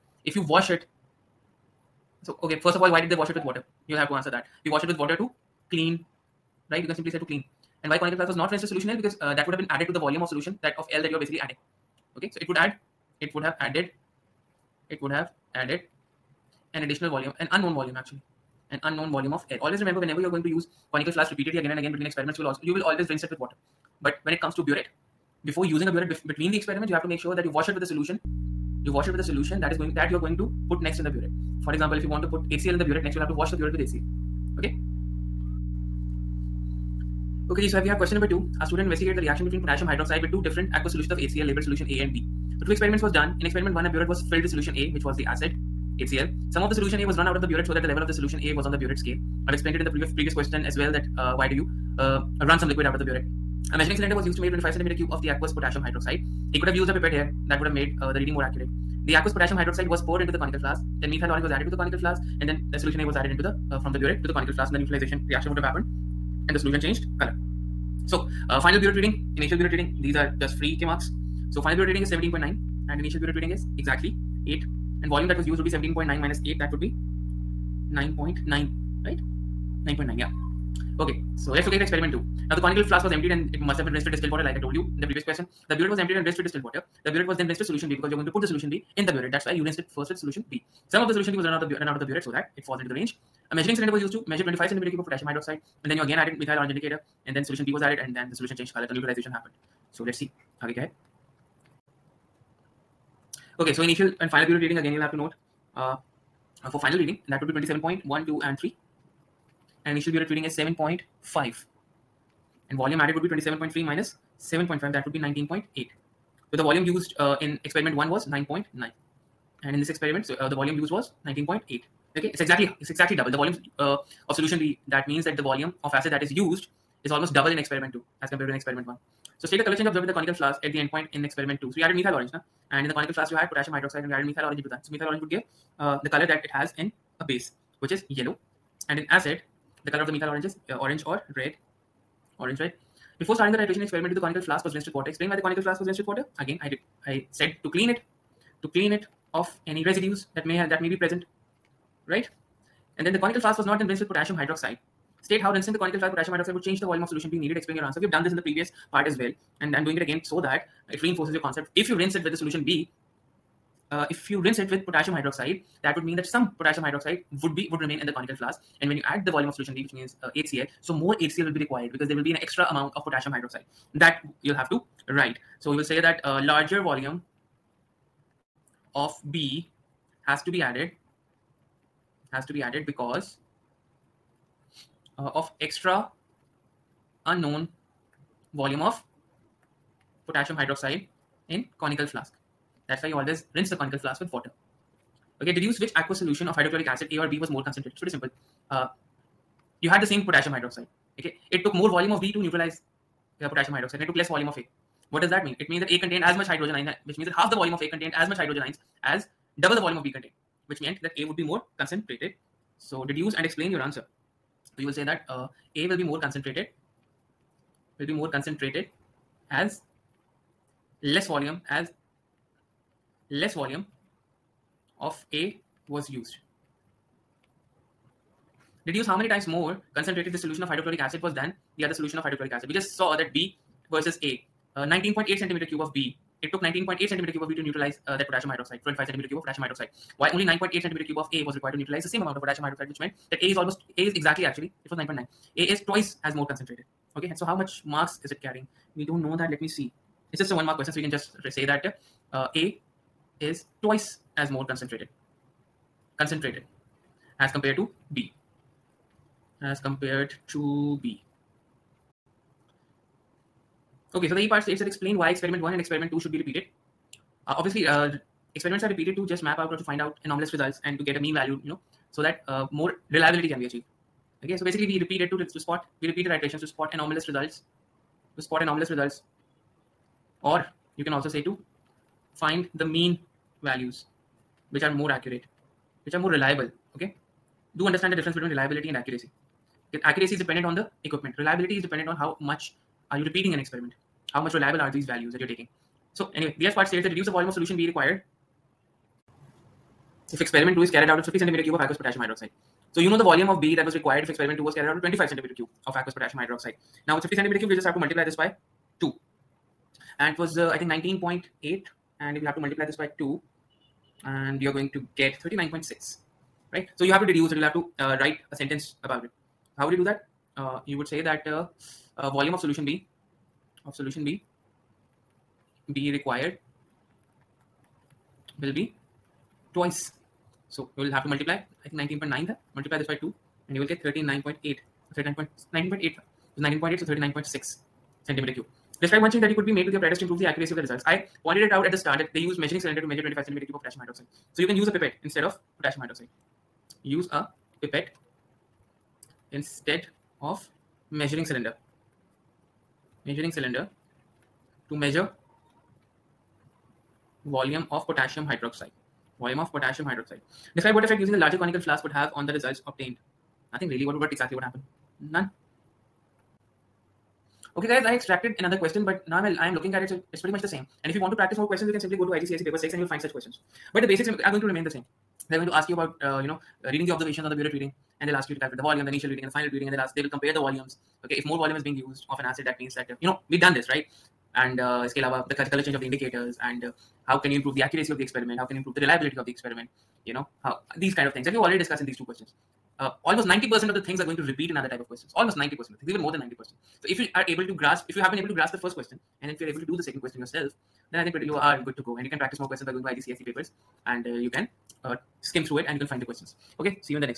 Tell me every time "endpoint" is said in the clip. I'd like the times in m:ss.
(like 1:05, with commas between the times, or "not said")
2:10.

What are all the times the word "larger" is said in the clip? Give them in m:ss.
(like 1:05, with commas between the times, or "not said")
2:56, 6:01.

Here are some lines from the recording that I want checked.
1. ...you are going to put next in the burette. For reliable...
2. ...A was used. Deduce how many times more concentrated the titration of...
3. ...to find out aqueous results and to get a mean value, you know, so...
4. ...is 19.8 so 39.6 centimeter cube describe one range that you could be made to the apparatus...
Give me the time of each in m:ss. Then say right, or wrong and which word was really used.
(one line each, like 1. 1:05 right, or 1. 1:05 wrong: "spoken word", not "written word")
1. 0:30 wrong: "example", not "reliable"
2. 3:45 wrong: "solution", not "titration"
3. 4:29 wrong: "anomalous", not "aqueous"
4. 5:36 wrong: "change", not "range".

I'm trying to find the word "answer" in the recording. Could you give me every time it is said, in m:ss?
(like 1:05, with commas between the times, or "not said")
0:04, 2:37, 3:33.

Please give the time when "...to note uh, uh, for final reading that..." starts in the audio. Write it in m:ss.
1:45.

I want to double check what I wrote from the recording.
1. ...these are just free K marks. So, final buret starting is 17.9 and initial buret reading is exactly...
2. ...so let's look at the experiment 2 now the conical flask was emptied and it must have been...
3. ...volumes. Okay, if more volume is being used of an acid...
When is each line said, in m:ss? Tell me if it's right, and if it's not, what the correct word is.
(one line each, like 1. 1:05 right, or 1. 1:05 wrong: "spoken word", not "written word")
1. 1:09 wrong: "reading", not "starting"
2. 1:21 right
3. 6:20 right.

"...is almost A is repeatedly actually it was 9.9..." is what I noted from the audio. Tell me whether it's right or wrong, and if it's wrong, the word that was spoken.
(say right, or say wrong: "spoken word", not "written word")
wrong: "exactly", not "repeatedly".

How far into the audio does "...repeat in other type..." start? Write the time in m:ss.
6:34.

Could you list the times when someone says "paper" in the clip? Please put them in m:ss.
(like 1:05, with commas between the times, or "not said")
6:12, 6:43.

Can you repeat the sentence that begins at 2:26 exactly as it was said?
Again, I, I said to clean it, to clean it of any residues that may have, that may be present, right?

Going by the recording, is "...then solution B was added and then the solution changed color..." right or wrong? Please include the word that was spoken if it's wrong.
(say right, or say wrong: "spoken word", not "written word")
right.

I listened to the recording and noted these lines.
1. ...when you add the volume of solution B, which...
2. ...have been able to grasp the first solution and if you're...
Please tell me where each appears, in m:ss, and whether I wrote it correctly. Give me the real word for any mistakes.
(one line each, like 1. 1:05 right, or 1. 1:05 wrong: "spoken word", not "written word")
1. 2:48 right
2. 6:38 wrong: "question", not "solution".